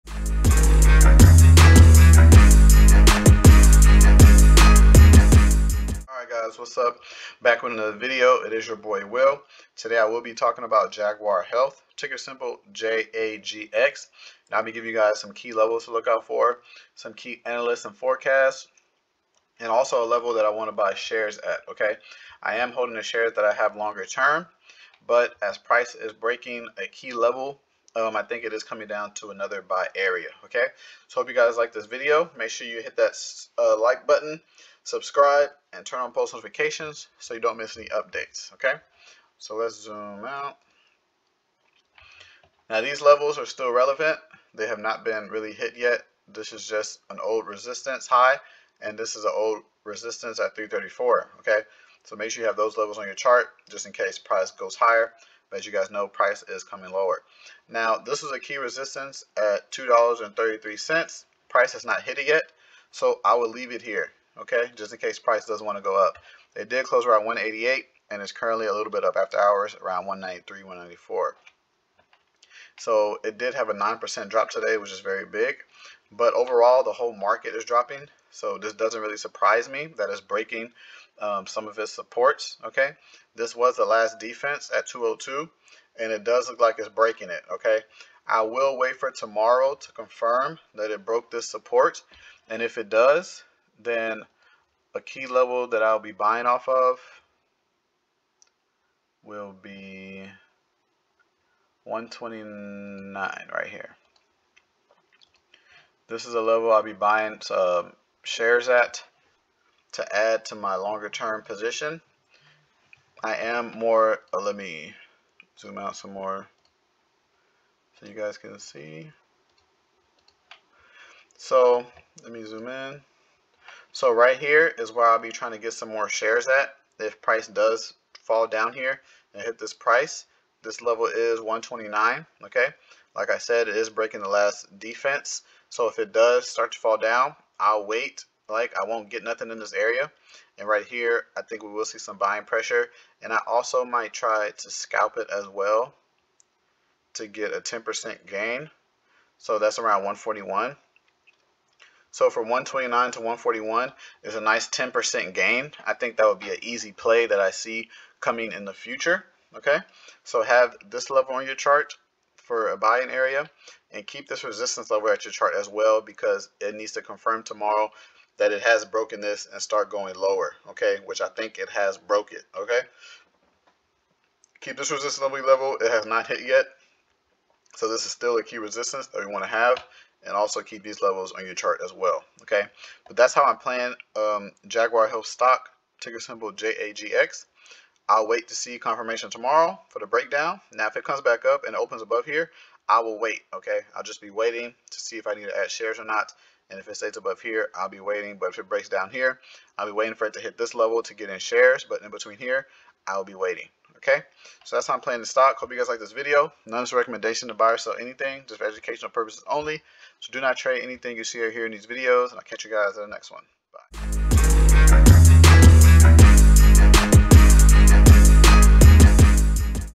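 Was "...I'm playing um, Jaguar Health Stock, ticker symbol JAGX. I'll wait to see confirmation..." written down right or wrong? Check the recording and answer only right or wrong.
right.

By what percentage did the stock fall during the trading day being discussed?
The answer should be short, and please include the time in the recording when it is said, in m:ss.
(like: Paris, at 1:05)
9%, at 1:13.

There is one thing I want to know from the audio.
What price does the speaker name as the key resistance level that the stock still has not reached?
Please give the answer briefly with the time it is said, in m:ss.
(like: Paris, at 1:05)
$2.33, at 0:59.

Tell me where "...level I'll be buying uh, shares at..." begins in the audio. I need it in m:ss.
1:46.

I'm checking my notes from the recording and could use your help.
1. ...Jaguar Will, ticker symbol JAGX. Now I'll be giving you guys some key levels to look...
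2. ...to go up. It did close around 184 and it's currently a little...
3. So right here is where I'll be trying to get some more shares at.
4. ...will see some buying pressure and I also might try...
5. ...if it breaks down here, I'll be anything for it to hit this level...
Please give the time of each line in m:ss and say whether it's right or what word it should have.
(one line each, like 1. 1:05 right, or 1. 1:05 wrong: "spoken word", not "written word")
1. 0:10 wrong: "Health", not "Will"
2. 1:05 wrong: "188", not "184"
3. 2:03 right
4. 2:21 right
5. 3:18 wrong: "waiting", not "anything".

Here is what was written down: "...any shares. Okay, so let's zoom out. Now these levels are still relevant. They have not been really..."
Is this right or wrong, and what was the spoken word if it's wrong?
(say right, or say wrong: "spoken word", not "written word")
wrong: "updates", not "shares".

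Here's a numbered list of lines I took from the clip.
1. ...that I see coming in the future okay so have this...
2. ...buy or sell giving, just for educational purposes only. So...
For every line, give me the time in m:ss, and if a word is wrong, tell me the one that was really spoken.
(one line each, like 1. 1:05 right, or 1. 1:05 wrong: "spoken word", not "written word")
1. 2:37 right
2. 3:27 wrong: "anything", not "giving".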